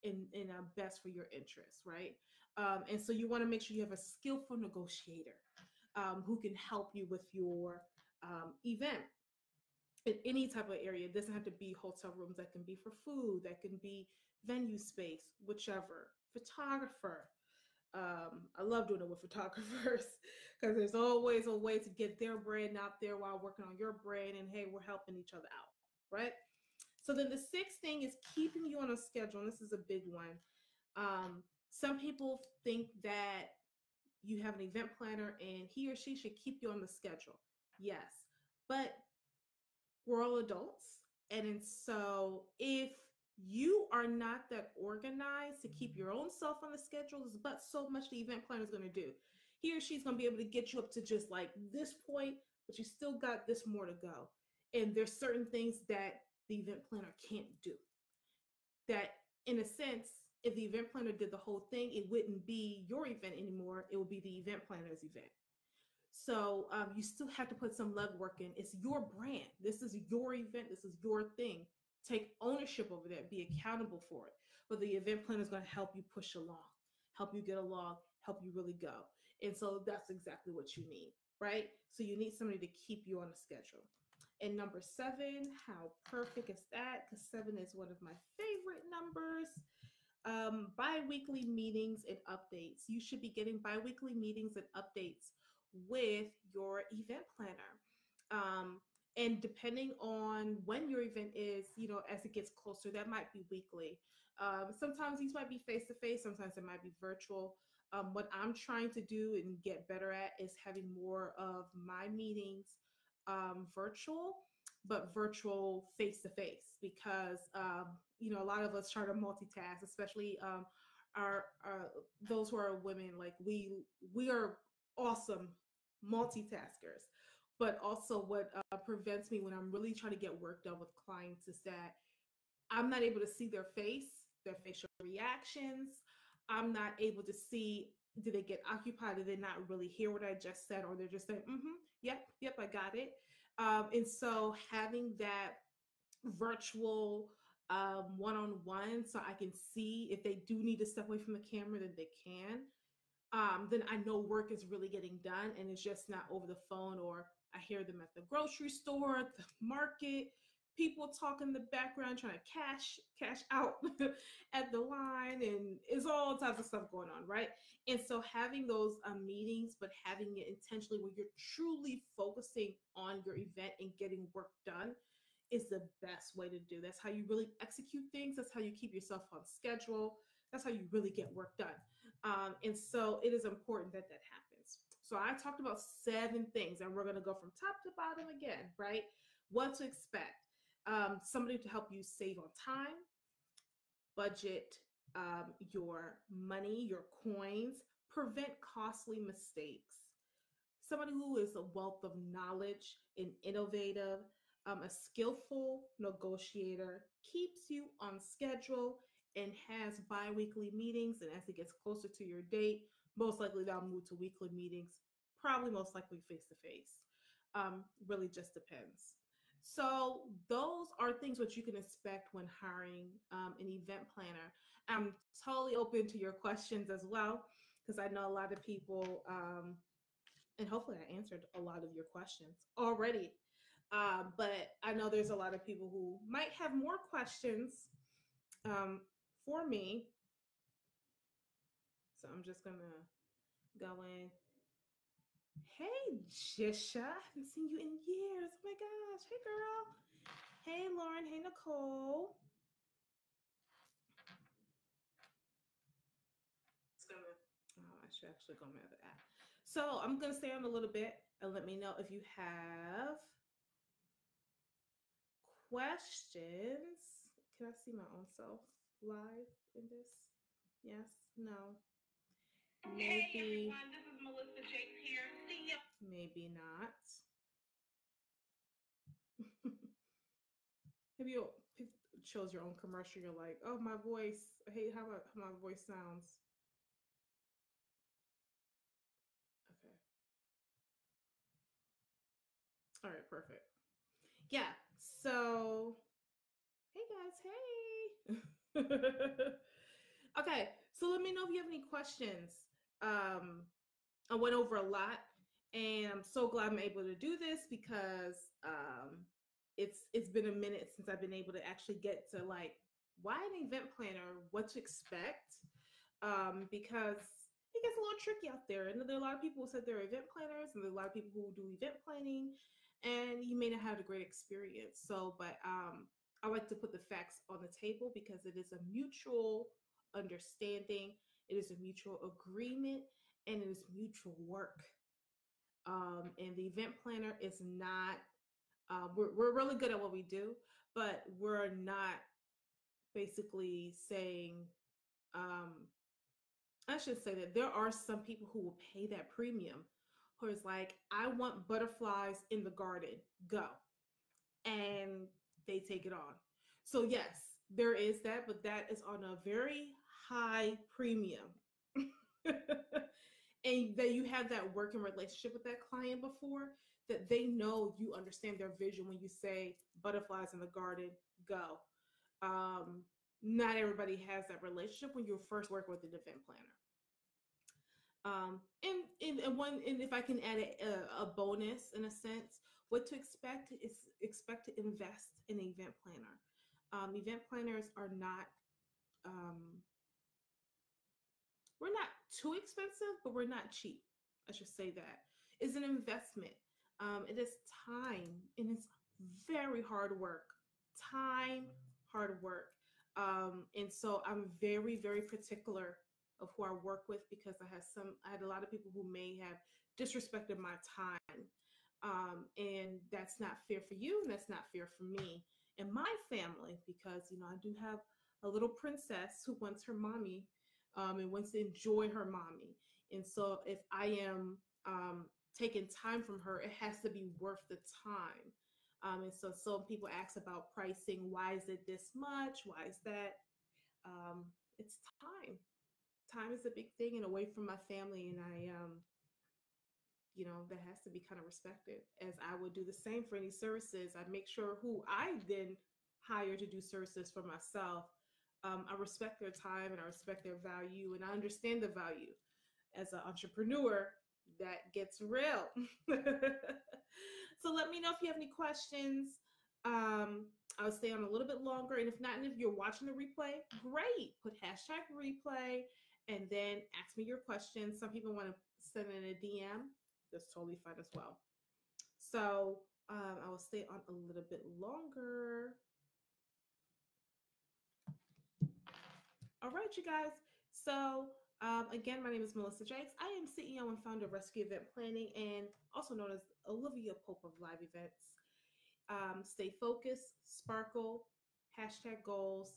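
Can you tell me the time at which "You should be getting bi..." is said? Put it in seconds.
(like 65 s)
92 s.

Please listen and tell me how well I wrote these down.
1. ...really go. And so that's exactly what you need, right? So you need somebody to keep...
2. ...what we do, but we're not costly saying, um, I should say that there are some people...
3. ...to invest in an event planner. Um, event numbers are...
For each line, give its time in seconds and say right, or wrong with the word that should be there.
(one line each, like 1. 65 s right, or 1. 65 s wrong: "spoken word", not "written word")
1. 78 s right
2. 339 s wrong: "basically", not "costly"
3. 384 s wrong: "planners", not "numbers".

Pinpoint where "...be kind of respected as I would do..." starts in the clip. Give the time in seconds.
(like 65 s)
441 s.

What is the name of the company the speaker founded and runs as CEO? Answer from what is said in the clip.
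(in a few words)
Rescue Event Planning.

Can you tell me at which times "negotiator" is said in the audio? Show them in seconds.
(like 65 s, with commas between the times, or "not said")
4 s, 205 s.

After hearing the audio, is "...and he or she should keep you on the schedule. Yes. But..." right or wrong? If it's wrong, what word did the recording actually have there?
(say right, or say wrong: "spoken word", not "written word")
right.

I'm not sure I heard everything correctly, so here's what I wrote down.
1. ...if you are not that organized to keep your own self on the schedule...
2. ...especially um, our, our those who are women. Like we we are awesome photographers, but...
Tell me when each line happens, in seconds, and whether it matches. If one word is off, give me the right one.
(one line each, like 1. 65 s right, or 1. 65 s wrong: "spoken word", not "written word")
1. 42 s right
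2. 119 s wrong: "multitaskers", not "photographers".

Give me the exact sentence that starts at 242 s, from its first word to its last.
So I'm just gonna go in Hey, Jisha.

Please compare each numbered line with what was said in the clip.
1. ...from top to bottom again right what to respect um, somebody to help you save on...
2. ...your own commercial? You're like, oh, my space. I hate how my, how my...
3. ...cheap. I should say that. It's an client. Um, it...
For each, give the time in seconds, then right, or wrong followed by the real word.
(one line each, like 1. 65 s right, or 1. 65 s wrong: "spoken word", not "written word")
1. 187 s wrong: "expect", not "respect"
2. 282 s wrong: "voice", not "space"
3. 393 s wrong: "investment", not "client".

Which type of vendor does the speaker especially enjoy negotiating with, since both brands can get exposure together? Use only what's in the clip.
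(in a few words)
Photographers.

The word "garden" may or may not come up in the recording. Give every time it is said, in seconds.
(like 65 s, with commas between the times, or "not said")
352 s, 370 s.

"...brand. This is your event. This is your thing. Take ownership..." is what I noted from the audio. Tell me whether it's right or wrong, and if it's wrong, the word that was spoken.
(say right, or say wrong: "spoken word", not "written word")
right.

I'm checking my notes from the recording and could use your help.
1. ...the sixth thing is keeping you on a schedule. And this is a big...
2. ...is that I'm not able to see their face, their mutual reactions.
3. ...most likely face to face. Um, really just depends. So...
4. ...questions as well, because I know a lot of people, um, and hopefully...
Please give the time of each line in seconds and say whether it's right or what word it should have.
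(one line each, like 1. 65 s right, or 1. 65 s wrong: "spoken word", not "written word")
1. 27 s right
2. 131 s wrong: "facial", not "mutual"
3. 215 s right
4. 226 s right.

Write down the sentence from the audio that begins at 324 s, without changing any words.
So, but um, I like to put the facts on the table because it is a mutual understanding.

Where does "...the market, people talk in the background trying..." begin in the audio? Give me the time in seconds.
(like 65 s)
159 s.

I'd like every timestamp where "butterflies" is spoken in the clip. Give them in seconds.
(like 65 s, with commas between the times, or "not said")
351 s, 369 s.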